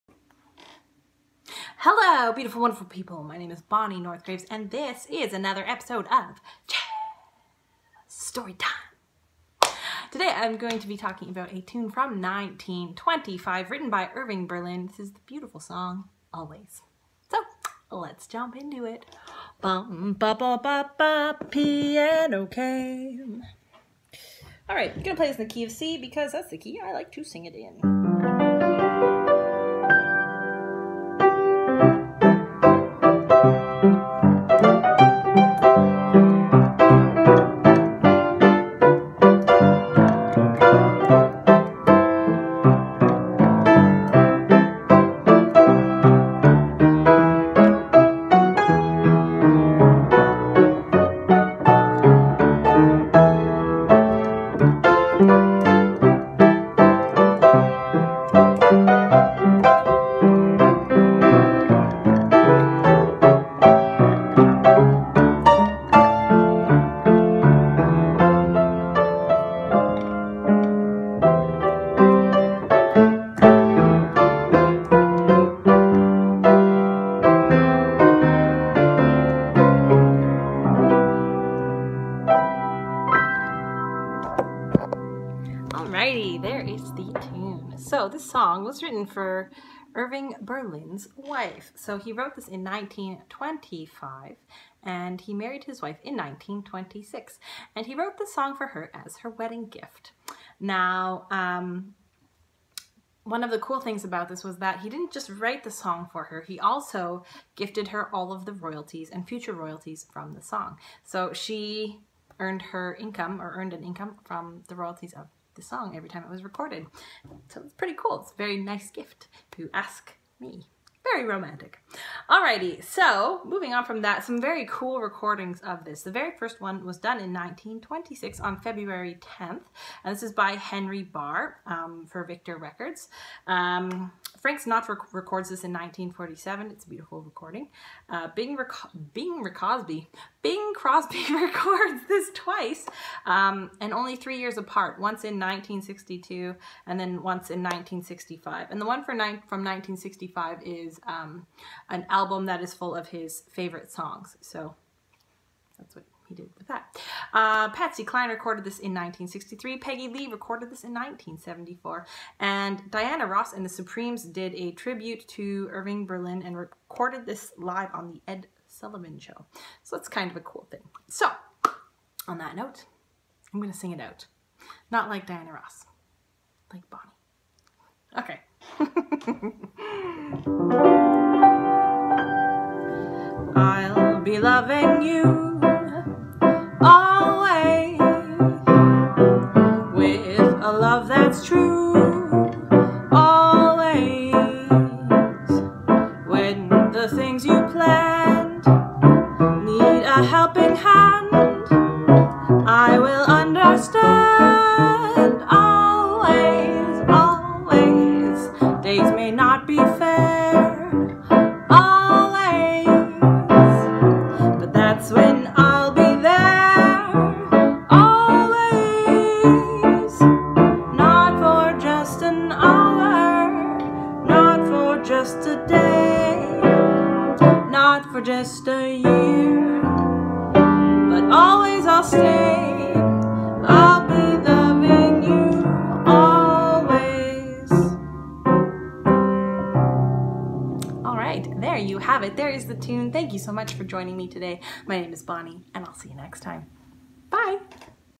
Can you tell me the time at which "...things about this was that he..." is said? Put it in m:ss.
1:43.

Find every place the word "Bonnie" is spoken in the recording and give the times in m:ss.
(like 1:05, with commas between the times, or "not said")
0:03, 2:56, 4:05.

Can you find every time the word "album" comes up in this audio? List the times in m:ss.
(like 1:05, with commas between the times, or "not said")
2:32.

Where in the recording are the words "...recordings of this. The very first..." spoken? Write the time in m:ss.
2:05.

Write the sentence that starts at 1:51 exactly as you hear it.
So she earned her income or earned an income from the royalties of the song every time it was recorded.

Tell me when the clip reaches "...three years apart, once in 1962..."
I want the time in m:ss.
2:24.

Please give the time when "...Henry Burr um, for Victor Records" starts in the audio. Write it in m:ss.
2:10.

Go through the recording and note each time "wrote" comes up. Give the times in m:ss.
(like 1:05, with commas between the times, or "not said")
1:32, 1:37.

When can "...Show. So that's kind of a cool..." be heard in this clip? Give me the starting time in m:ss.
2:49.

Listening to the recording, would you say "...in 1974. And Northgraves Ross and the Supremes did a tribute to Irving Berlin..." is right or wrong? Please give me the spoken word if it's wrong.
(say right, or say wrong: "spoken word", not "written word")
wrong: "Diana", not "Northgraves".